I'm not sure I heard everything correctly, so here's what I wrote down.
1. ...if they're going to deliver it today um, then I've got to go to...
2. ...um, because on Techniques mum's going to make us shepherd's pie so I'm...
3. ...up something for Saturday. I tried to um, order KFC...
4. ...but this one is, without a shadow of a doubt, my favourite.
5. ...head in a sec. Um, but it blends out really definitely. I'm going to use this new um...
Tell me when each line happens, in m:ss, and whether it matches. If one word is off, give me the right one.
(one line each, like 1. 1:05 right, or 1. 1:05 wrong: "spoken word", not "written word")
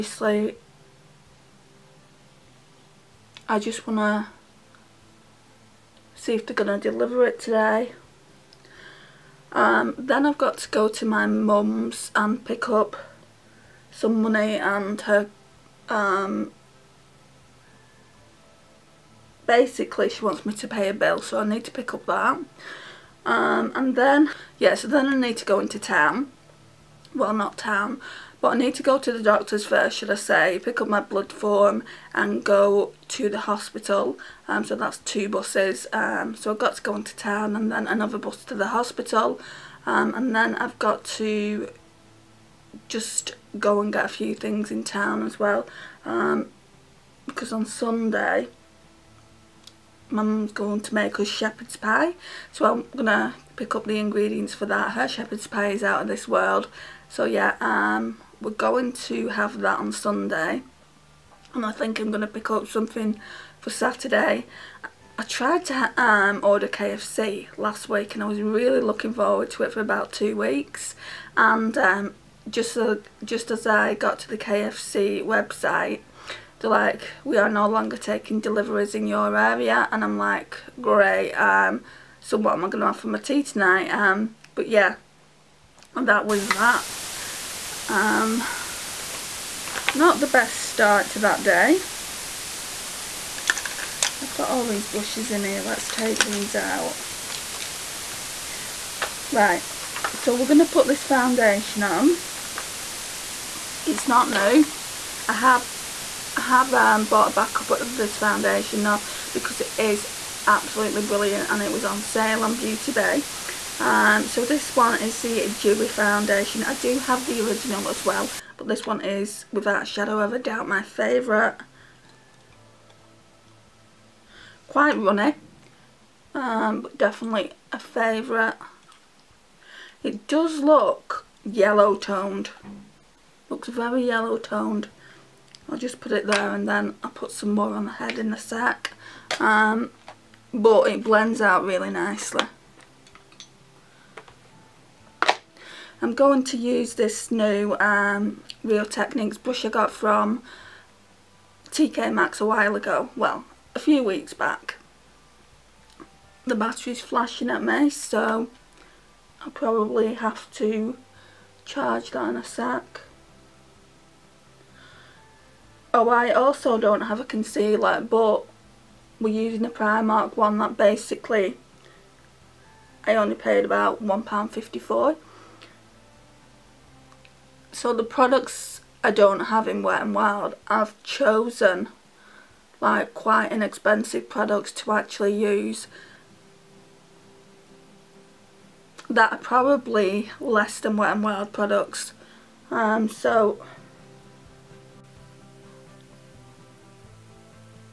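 1. 0:06 right
2. 0:46 wrong: "Sunday", not "Techniques"
3. 1:02 right
4. 1:58 right
5. 2:17 wrong: "nicely", not "definitely".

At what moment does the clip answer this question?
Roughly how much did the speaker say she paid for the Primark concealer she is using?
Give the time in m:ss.
2:54.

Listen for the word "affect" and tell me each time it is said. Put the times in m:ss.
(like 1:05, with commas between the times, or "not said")
not said.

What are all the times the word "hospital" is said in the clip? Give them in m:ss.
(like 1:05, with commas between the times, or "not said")
0:33, 0:38.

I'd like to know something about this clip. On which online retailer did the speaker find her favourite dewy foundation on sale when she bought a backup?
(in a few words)
Beauty Bay.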